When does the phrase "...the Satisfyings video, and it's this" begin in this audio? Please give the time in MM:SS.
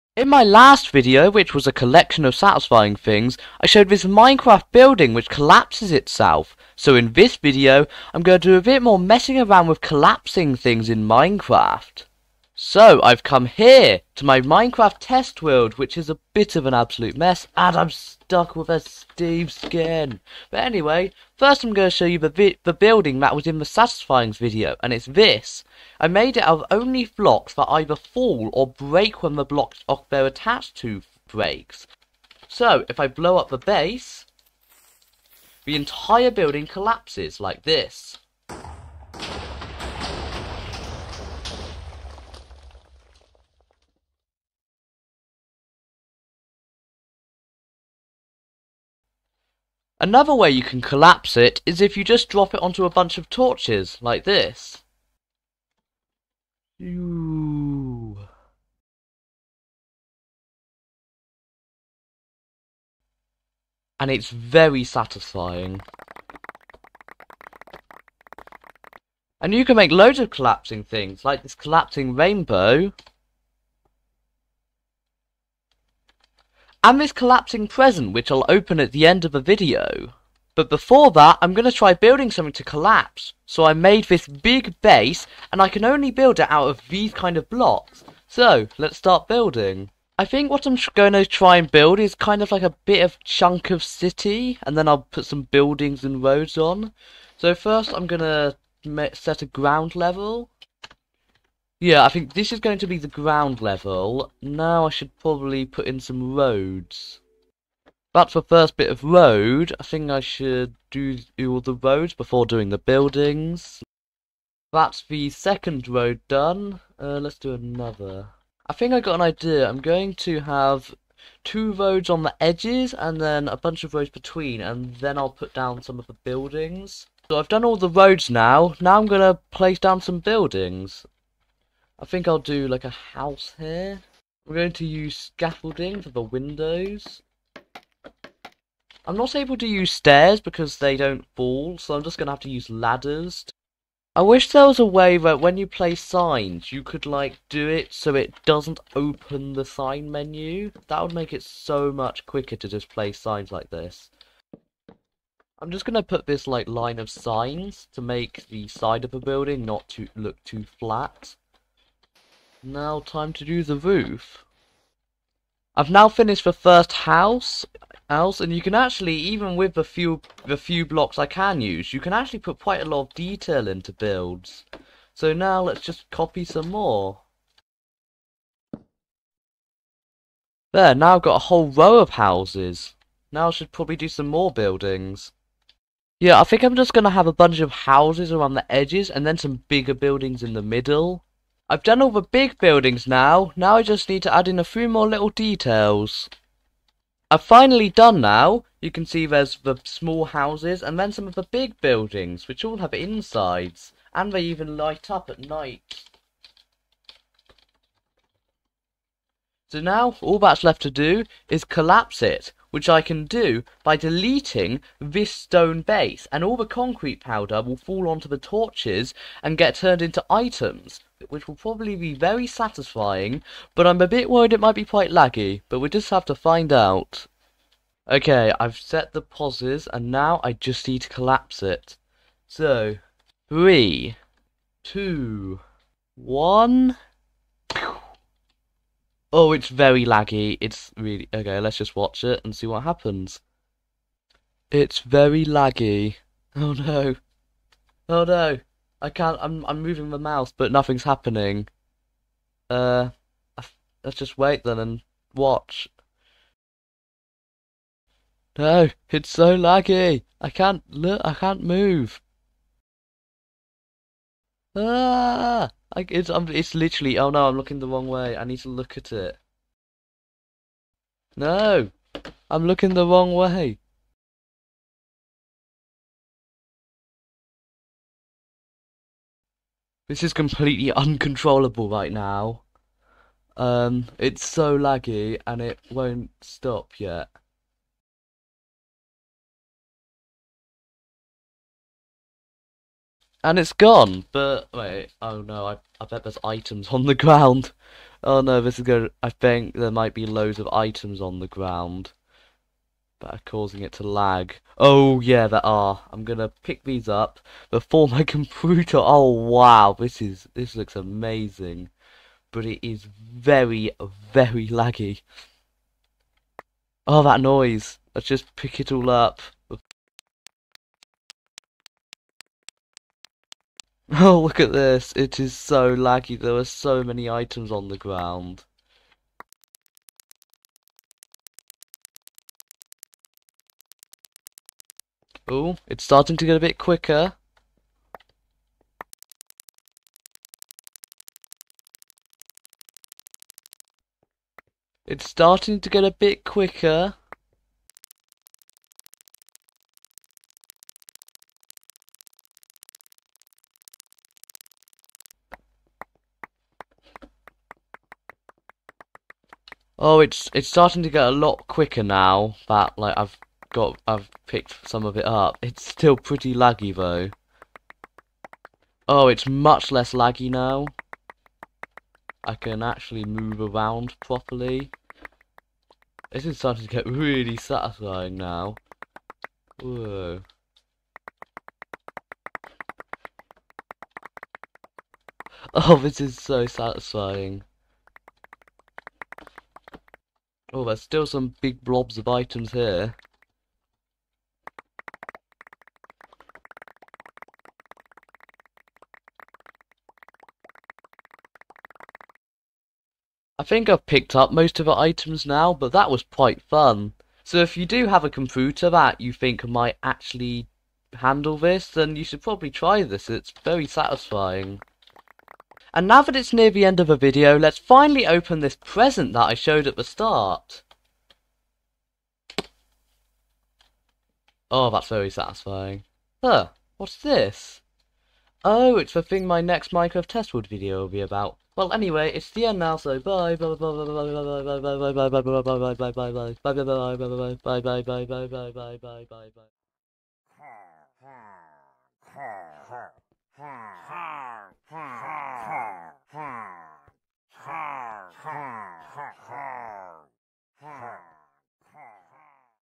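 00:23.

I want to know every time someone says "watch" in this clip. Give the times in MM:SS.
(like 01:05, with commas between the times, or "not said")
04:01, 04:15.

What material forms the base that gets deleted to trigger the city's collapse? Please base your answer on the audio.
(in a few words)
Stone.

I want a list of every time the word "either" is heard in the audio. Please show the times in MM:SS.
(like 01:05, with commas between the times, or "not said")
00:27.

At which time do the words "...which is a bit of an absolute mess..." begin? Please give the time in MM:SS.
00:15.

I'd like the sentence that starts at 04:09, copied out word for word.
I'm I'm moving the mouse, but nothing's happening.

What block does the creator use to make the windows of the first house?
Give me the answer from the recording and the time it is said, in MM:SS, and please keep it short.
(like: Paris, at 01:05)
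Scaffolding, at 02:15.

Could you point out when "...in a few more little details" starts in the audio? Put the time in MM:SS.
03:14.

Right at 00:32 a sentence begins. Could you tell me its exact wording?
So, if I blow up the base, the entire building collapses like this.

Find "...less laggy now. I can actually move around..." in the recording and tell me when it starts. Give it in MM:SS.
06:09.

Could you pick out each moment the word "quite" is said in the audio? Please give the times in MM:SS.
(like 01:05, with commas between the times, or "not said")
02:52, 03:44, 06:46.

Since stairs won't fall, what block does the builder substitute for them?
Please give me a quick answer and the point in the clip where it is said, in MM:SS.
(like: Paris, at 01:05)
Ladders, at 02:22.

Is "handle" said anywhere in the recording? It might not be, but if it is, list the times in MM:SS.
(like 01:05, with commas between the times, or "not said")
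06:51.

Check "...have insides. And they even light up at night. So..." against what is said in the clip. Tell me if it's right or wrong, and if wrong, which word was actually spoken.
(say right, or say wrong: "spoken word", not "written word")
right.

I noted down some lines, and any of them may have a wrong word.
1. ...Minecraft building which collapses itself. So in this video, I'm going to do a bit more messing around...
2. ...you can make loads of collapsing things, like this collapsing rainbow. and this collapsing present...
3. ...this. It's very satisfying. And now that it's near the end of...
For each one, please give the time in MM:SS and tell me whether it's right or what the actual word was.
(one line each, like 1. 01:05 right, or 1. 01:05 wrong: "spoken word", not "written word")
1. 00:04 right
2. 01:09 right
3. 06:53 right.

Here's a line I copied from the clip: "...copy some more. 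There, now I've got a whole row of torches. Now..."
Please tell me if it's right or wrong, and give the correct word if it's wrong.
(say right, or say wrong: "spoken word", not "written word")
wrong: "houses", not "torches".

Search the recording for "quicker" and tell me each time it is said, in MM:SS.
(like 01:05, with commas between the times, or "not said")
02:32, 05:36, 05:46, 06:01.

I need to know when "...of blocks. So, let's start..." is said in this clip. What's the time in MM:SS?
01:27.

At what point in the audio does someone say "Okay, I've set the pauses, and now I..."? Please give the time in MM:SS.
03:48.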